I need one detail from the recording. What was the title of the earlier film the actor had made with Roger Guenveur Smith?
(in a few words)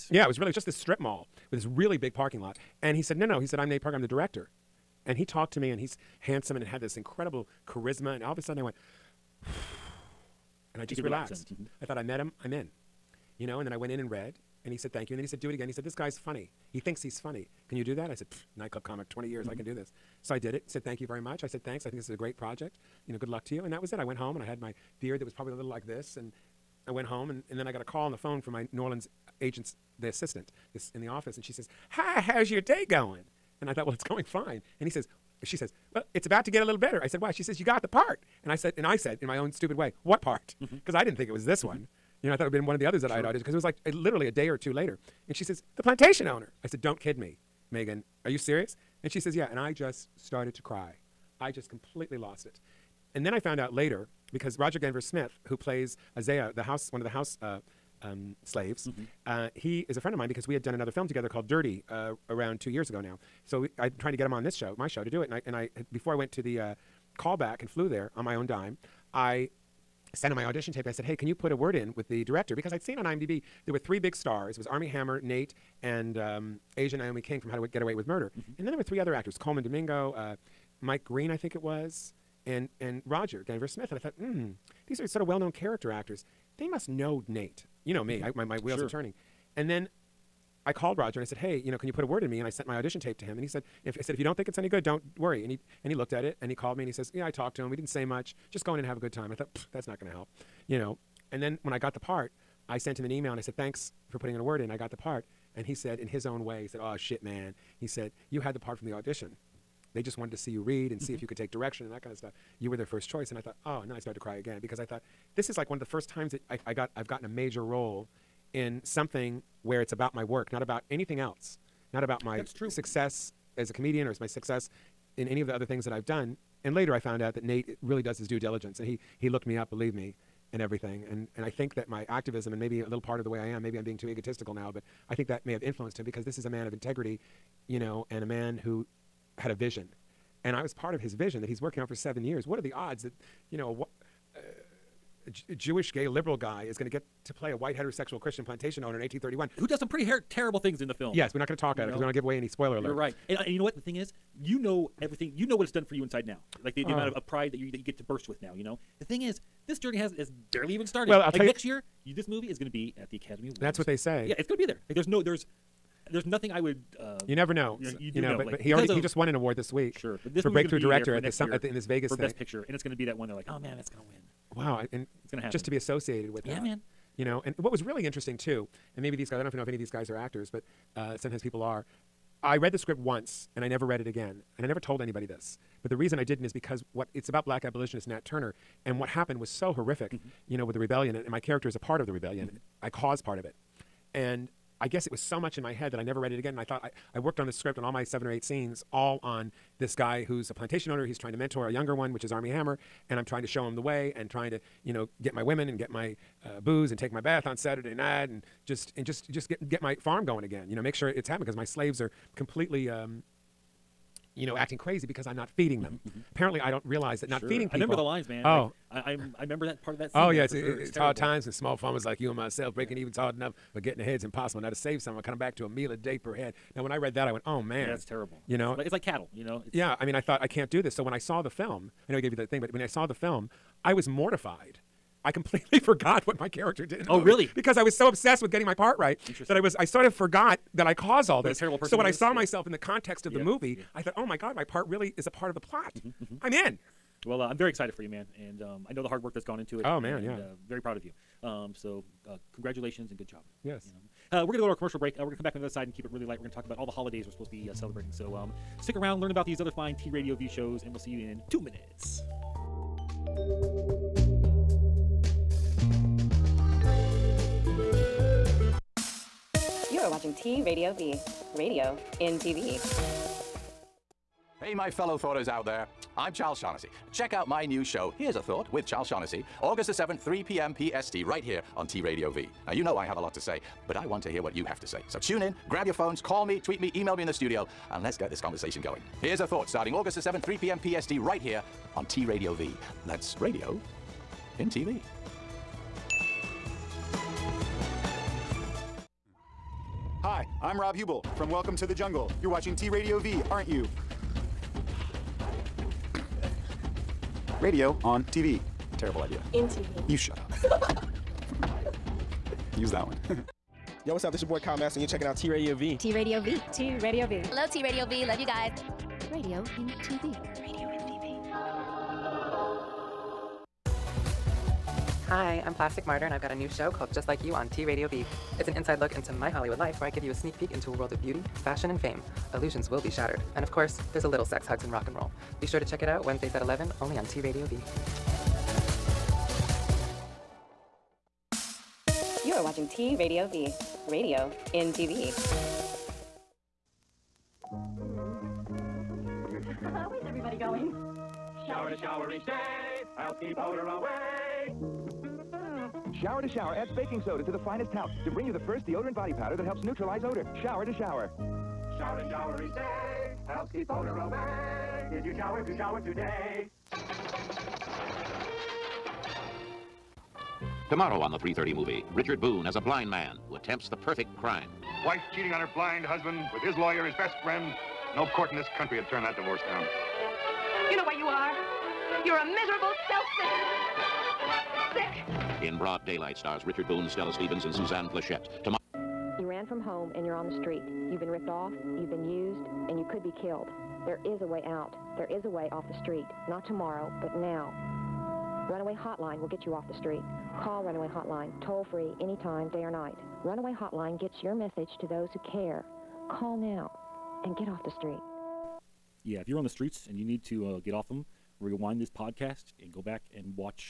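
Dirty.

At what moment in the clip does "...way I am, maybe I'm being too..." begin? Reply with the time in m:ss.
2:13.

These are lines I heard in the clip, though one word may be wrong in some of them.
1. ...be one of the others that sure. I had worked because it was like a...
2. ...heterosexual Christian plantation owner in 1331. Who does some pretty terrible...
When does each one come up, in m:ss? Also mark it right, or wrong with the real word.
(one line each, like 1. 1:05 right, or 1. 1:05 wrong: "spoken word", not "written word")
1. 0:42 wrong: "auditioned", not "worked"
2. 2:27 wrong: "1831", not "1331".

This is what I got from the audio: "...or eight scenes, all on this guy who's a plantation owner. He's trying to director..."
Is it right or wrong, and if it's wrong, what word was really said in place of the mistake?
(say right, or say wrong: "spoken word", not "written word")
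wrong: "mentor", not "director".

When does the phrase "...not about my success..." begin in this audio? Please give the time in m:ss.
2:01.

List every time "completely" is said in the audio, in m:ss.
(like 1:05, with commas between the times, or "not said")
0:51, 3:32, 3:55.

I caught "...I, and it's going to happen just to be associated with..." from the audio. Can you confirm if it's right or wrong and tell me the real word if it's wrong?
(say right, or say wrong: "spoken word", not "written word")
right.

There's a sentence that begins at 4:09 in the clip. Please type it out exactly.
Oh man, and, yeah, uh, very proud of you.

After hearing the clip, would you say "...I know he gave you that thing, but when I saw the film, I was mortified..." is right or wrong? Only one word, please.
right.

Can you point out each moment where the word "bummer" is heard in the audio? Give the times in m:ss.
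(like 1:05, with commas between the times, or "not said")
not said.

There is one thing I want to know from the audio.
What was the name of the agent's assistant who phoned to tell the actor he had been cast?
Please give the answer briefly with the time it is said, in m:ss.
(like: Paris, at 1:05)
Megan, at 0:47.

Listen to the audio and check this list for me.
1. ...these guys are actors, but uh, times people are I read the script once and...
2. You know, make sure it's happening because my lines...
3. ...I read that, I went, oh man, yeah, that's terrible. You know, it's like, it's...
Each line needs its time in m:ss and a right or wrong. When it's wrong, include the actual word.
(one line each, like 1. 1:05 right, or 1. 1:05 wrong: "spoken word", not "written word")
1. 2:59 wrong: "sometimes", not "times"
2. 3:30 wrong: "slaves", not "lines"
3. 3:46 right.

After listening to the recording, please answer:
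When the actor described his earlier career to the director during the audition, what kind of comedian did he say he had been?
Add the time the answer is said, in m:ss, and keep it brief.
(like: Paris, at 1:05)
Nightclub comic, at 0:18.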